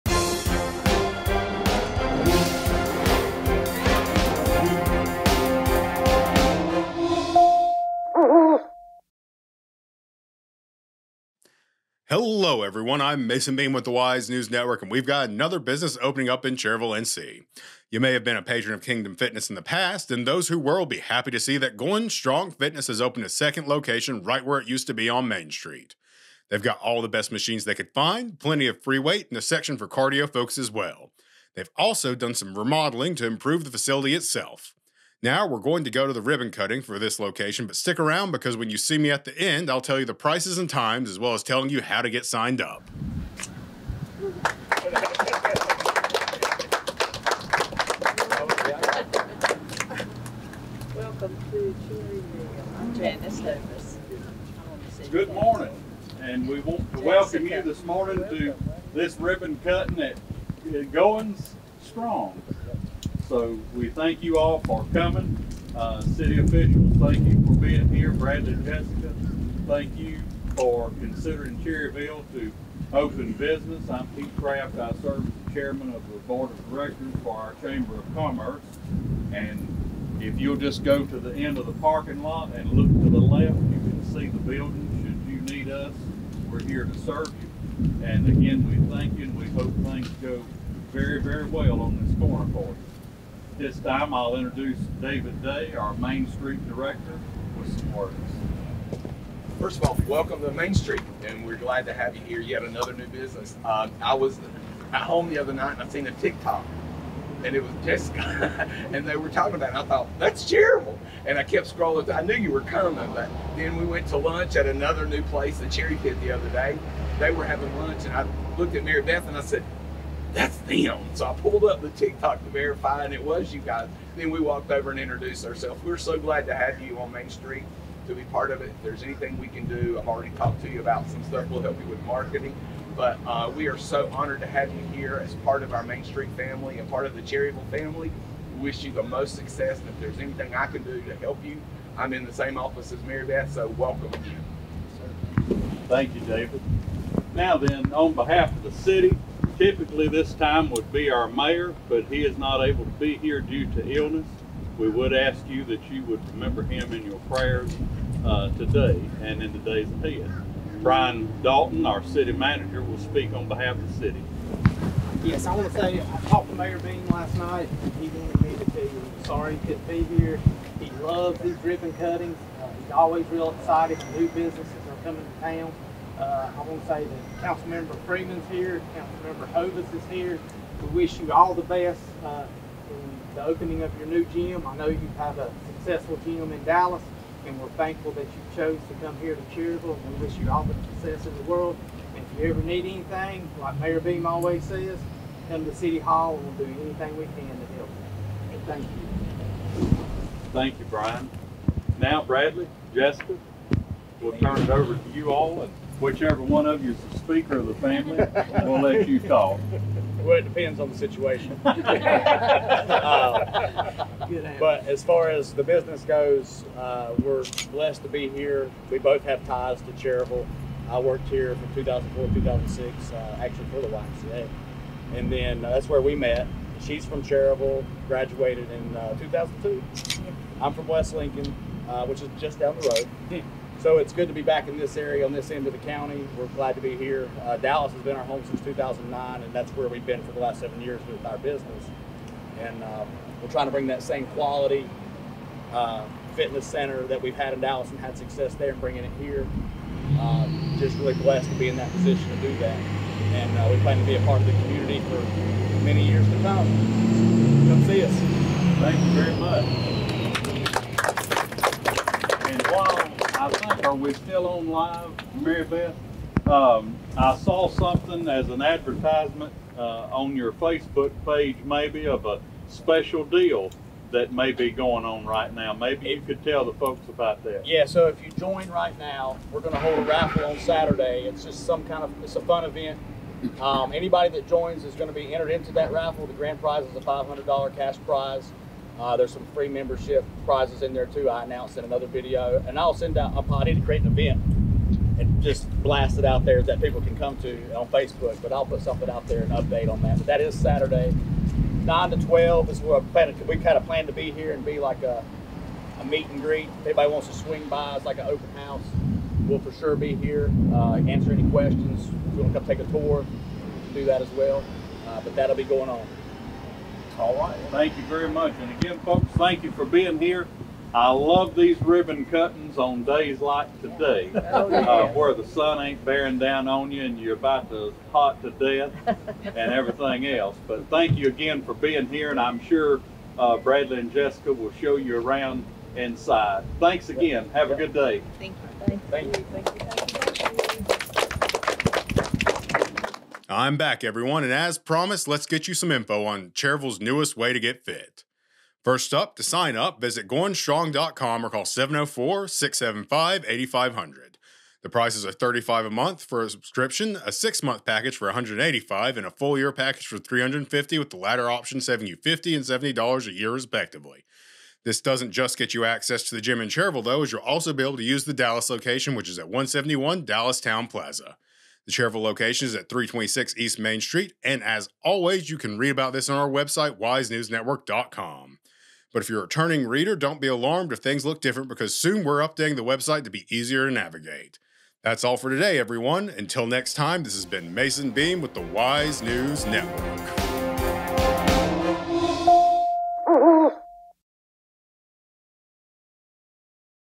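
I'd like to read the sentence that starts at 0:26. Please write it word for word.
They've got all the best machines they could find, plenty of free weight, and a section for cardio folks as well.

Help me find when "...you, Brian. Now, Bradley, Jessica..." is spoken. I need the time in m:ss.
3:20.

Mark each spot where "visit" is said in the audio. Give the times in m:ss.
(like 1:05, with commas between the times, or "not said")
5:49.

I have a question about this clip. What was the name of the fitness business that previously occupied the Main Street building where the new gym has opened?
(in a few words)
Kingdom Fitness.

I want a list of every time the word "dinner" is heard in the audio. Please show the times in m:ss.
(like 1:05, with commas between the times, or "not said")
not said.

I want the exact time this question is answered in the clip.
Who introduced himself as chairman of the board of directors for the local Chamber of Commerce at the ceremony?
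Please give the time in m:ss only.
1:14.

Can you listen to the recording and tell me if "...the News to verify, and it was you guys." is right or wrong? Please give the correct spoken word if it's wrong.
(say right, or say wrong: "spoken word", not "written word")
wrong: "TikTok", not "News".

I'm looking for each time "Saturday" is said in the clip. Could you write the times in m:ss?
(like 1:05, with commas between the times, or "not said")
4:40, 5:00.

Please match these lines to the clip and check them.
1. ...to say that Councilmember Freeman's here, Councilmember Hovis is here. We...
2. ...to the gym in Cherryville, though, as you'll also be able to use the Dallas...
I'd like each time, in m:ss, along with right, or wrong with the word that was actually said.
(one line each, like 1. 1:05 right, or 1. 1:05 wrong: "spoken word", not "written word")
1. 2:56 right
2. 6:06 right.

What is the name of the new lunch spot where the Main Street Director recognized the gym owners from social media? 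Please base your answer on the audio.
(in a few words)
the Cherry Pit.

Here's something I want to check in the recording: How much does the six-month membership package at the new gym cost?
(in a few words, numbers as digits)
$185.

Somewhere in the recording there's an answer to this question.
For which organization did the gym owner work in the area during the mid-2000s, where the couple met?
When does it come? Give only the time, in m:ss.
3:43.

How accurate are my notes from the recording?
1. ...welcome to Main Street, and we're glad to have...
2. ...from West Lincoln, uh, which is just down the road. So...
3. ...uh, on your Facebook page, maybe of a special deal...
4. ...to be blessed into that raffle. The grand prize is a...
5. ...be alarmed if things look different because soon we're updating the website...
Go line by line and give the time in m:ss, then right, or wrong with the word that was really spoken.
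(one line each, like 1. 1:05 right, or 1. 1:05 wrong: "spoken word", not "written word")
1. 1:40 right
2. 3:50 right
3. 4:29 right
4. 4:45 wrong: "entered", not "blessed"
5. 6:20 right.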